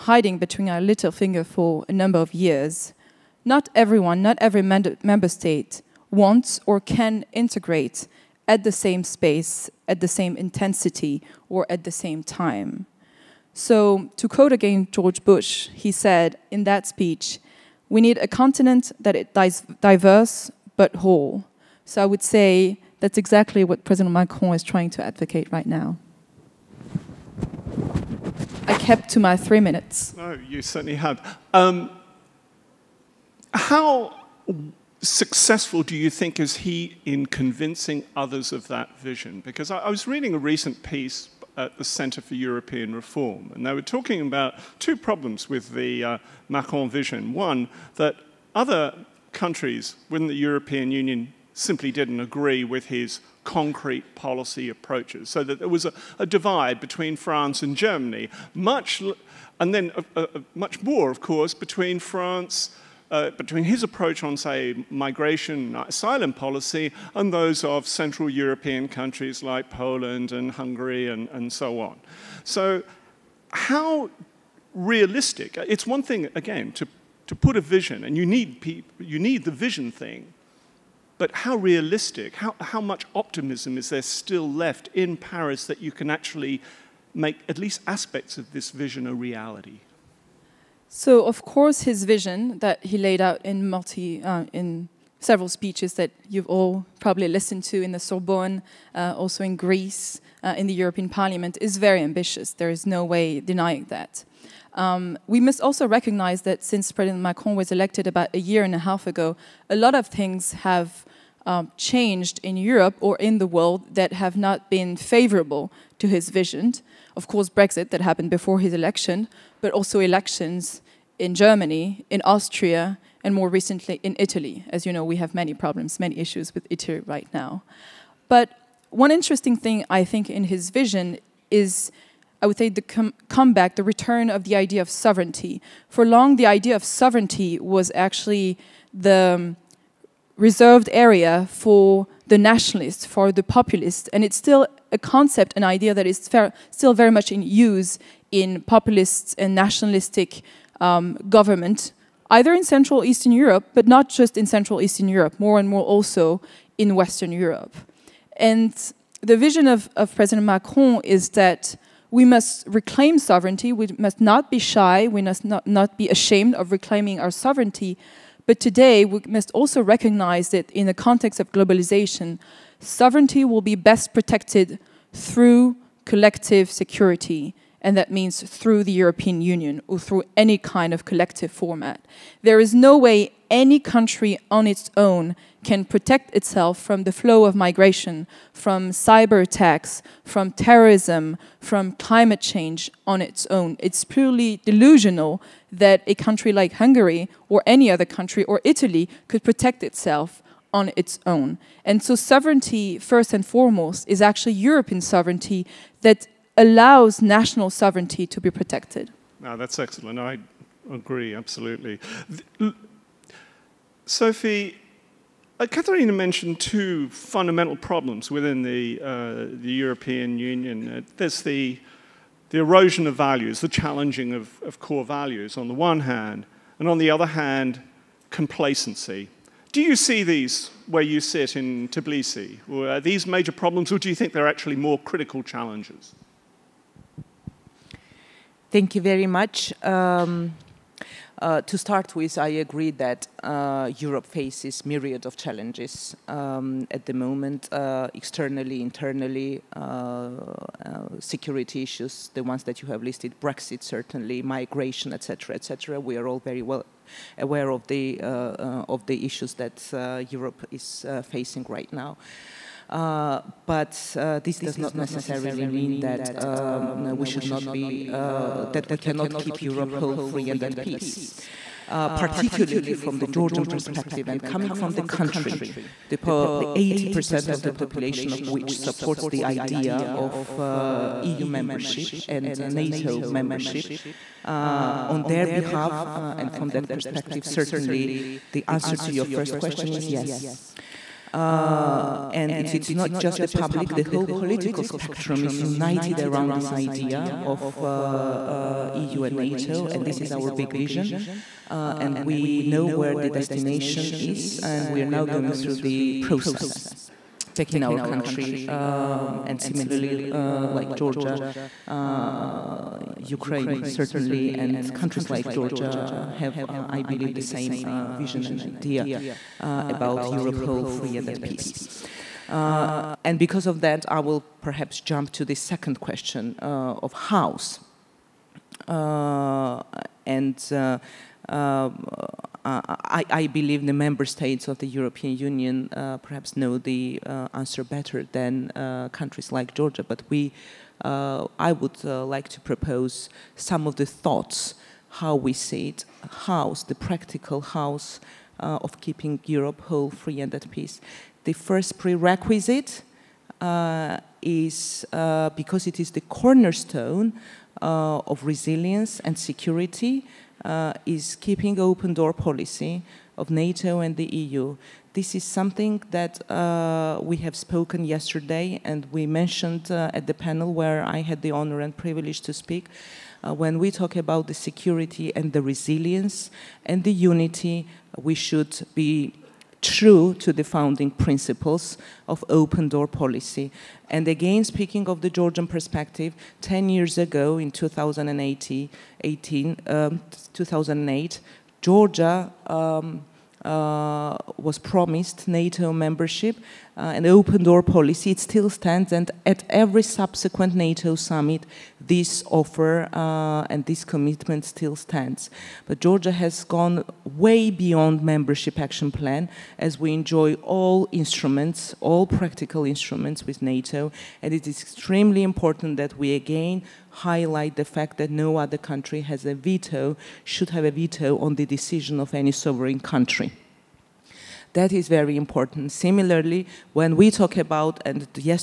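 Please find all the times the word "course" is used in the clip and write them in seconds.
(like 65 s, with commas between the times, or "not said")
61 s, 91 s, 117 s.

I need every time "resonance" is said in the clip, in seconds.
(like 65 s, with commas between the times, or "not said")
not said.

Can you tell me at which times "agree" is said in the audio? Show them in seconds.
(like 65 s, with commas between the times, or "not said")
52 s, 210 s, 242 s.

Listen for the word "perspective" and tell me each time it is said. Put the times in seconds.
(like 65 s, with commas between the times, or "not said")
273 s, 286 s, 385 s.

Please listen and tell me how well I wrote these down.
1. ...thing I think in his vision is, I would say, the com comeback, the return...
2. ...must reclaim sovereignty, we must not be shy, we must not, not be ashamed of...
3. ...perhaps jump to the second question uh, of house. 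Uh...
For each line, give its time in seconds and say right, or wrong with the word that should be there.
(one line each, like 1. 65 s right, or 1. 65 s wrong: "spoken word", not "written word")
1. 129 s right
2. 162 s right
3. 324 s right.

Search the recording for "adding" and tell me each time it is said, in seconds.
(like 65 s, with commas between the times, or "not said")
not said.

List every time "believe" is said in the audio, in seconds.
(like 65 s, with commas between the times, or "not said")
317 s, 333 s.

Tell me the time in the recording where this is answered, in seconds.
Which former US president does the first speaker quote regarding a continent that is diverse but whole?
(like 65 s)
14 s.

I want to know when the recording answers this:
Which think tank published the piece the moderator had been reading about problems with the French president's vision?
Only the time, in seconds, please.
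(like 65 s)
41 s.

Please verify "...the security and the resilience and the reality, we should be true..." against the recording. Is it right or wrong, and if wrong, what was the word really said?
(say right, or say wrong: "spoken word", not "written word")
wrong: "unity", not "reality".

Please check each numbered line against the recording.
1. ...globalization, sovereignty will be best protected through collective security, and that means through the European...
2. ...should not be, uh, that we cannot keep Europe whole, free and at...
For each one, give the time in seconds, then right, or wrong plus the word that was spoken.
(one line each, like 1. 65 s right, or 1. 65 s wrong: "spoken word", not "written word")
1. 171 s right
2. 267 s right.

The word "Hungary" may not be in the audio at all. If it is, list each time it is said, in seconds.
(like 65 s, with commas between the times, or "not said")
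70 s, 196 s.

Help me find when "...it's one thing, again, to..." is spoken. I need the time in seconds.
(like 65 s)
75 s.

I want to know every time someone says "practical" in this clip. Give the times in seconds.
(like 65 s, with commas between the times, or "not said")
346 s, 412 s.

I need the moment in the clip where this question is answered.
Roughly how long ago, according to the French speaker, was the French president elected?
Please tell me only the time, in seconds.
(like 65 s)
108 s.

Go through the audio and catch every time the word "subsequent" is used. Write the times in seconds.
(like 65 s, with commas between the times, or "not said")
400 s.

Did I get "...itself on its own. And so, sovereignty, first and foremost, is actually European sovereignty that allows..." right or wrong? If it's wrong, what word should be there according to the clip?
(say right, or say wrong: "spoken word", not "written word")
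right.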